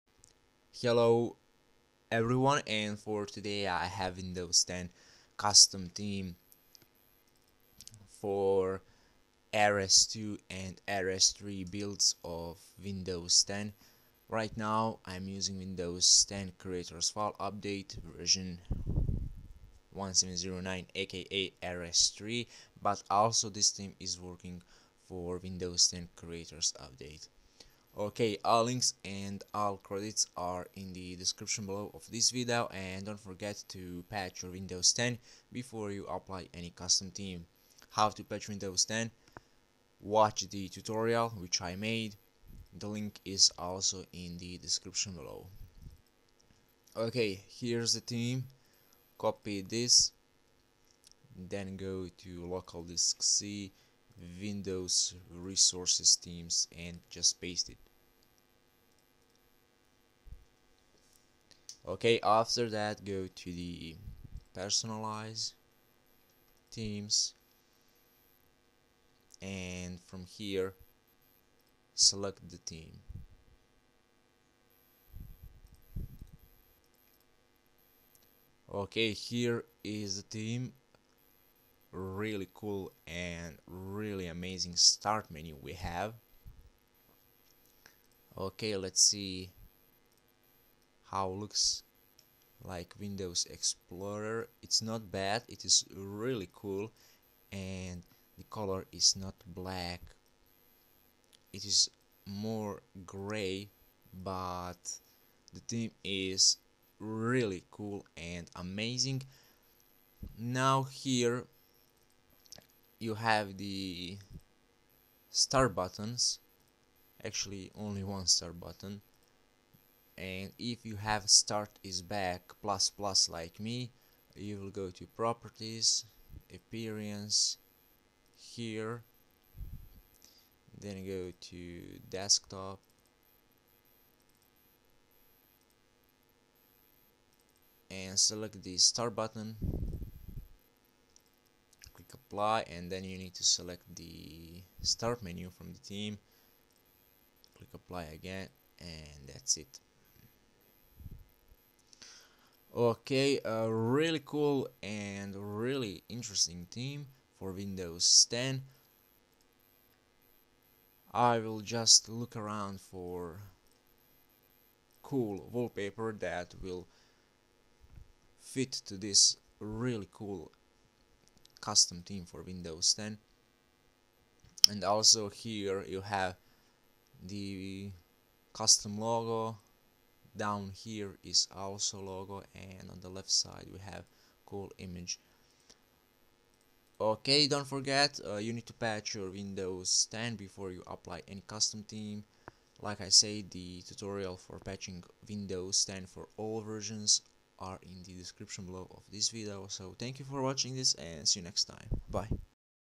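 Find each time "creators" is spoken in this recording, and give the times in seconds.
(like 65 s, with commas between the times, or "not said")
16 s, 26 s.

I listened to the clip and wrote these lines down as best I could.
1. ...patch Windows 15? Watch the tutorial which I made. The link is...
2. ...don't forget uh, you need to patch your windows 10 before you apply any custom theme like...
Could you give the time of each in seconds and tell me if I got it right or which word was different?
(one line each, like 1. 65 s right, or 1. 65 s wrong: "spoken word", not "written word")
1. 38 s wrong: "10", not "15"
2. 187 s right.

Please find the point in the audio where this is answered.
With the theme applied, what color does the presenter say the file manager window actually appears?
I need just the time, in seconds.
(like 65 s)
103 s.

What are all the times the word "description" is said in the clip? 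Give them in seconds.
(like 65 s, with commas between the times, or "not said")
31 s, 44 s, 198 s.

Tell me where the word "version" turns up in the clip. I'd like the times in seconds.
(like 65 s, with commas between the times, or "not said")
18 s, 196 s.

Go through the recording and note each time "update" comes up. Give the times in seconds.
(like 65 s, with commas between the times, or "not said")
17 s, 26 s.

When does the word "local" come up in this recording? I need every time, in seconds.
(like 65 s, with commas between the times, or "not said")
52 s.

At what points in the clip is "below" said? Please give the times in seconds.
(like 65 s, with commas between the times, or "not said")
31 s, 45 s, 198 s.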